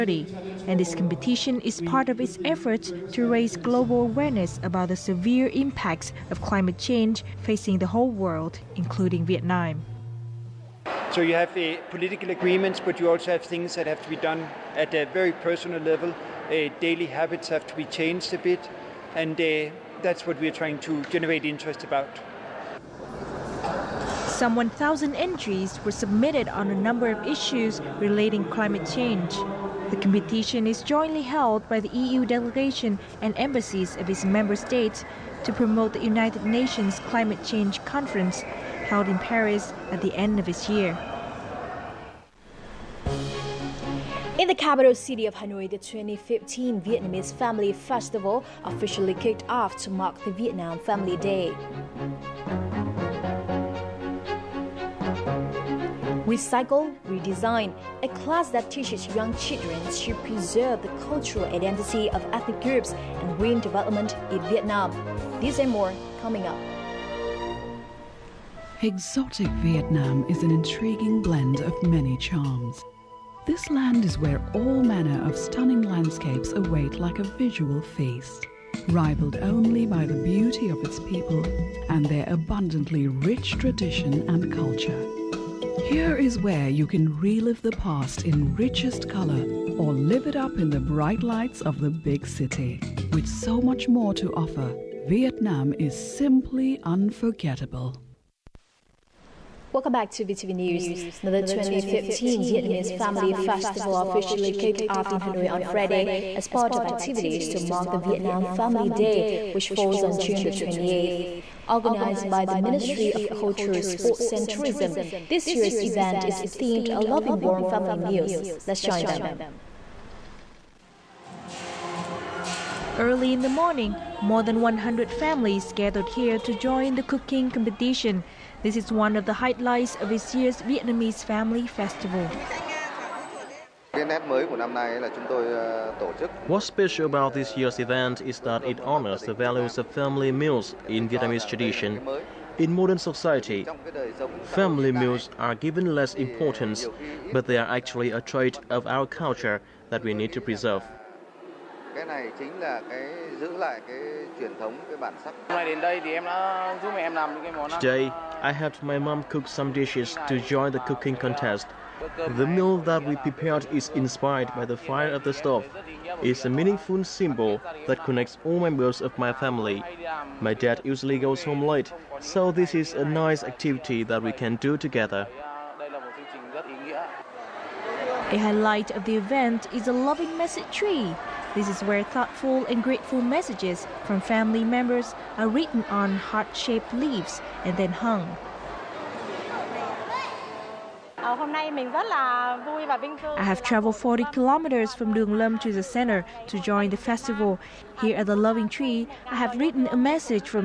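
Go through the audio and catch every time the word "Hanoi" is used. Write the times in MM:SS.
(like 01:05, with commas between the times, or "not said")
00:45, 01:45.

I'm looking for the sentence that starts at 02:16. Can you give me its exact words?
What's special about this year's event is that it honors the values of family meals in Vietnamese tradition.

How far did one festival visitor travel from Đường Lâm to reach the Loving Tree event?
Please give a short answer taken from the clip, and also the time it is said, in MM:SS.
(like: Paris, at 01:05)
40 kilometers, at 03:13.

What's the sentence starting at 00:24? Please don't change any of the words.
Some 1,000 entries were submitted on a number of issues relating climate change.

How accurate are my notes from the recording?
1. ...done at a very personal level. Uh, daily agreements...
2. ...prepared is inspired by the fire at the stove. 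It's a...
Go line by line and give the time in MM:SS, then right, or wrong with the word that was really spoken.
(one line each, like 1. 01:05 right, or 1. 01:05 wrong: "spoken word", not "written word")
1. 00:14 wrong: "habits", not "agreements"
2. 02:43 right.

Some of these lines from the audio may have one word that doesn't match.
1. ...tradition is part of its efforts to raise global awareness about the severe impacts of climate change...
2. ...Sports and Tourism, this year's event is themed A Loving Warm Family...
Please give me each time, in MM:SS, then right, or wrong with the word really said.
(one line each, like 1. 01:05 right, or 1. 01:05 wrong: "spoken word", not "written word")
1. 00:00 wrong: "competition", not "tradition"
2. 01:53 right.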